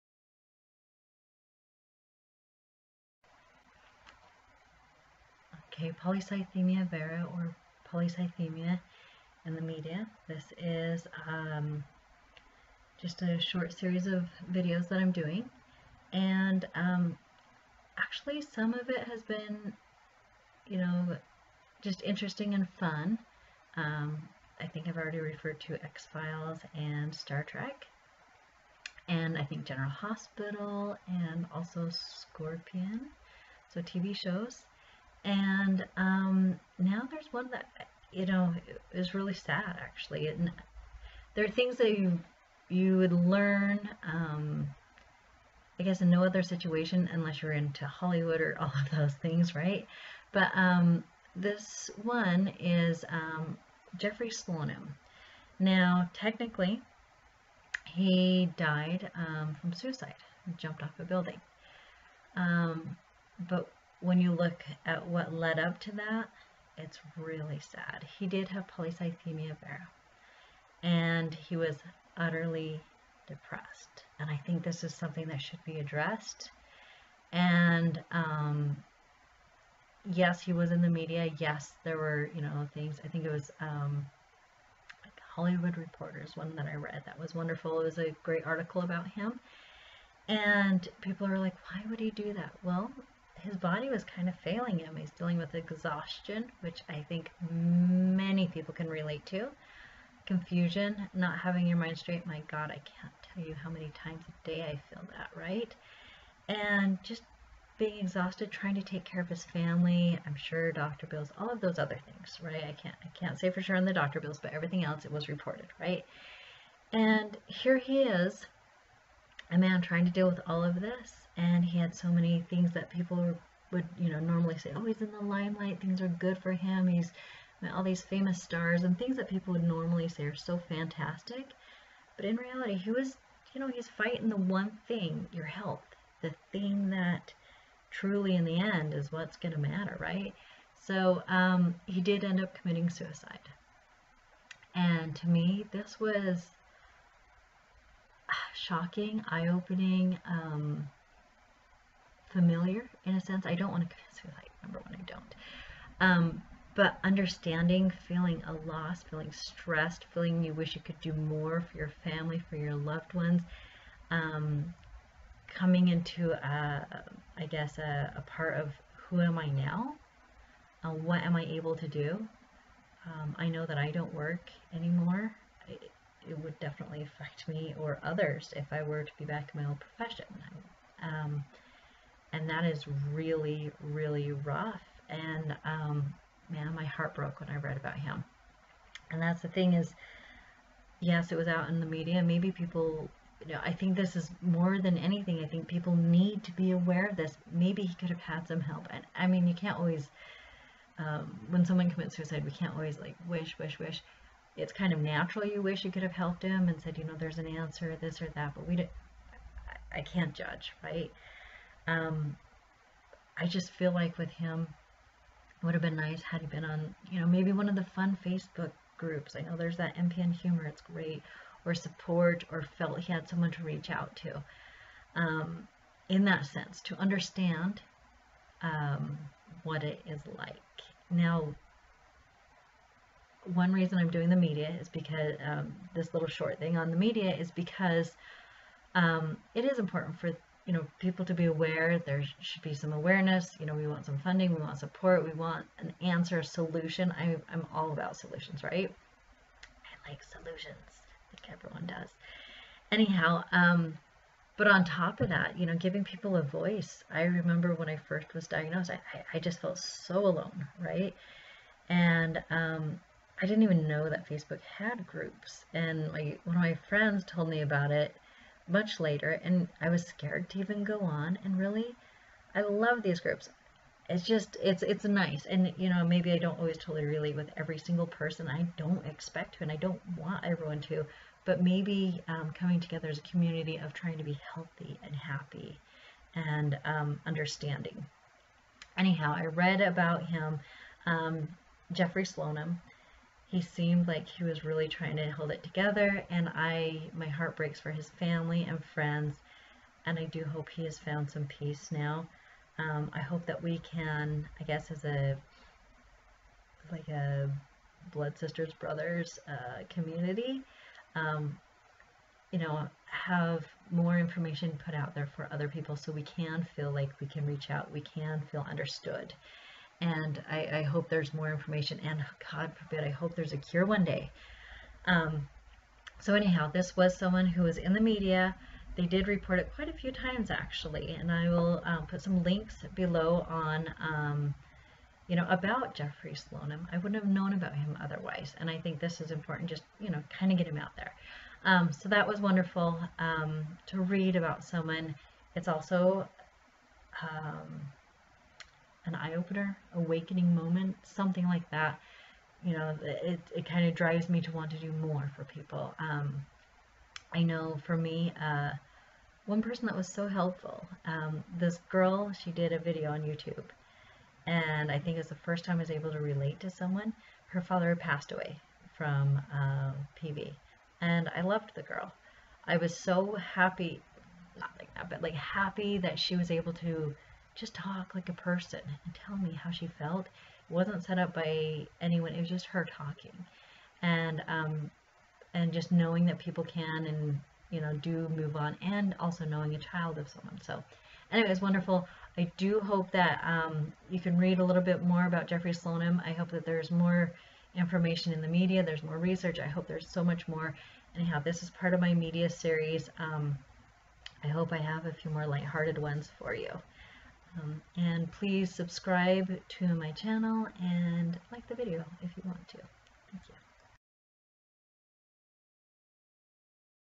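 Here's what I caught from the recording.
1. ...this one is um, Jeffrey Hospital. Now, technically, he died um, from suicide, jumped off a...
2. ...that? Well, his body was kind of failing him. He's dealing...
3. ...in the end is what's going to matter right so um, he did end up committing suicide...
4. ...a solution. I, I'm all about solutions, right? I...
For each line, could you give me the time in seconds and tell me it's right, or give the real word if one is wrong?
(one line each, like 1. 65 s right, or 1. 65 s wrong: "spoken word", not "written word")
1. 51 s wrong: "Slonim", not "Hospital"
2. 92 s right
3. 138 s right
4. 246 s right.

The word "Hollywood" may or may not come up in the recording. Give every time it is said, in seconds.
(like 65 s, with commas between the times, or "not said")
47 s, 85 s.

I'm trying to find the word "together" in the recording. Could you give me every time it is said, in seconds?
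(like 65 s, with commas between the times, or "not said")
282 s, 295 s.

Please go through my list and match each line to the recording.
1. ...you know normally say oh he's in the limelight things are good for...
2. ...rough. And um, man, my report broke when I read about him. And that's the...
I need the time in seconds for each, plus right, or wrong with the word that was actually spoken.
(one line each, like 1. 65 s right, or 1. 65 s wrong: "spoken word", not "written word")
1. 123 s right
2. 184 s wrong: "heart", not "report".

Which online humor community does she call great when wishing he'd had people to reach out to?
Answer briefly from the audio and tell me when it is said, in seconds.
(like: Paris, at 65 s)
MPN humor, at 219 s.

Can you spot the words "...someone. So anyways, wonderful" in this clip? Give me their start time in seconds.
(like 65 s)
390 s.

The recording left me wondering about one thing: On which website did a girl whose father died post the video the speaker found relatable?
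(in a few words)
YouTube.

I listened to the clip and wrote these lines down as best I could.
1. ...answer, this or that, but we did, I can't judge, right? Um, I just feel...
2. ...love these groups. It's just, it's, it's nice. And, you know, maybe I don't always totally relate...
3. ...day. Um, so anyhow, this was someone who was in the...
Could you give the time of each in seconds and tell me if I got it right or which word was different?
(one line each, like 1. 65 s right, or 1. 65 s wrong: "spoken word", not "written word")
1. 207 s right
2. 272 s right
3. 324 s right.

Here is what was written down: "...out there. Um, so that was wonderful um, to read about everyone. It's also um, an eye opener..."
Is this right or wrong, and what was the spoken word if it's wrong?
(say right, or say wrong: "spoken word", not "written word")
wrong: "someone", not "everyone".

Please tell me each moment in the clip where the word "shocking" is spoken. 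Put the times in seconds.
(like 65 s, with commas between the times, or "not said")
148 s.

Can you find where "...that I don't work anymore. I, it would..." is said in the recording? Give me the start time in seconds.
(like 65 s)
173 s.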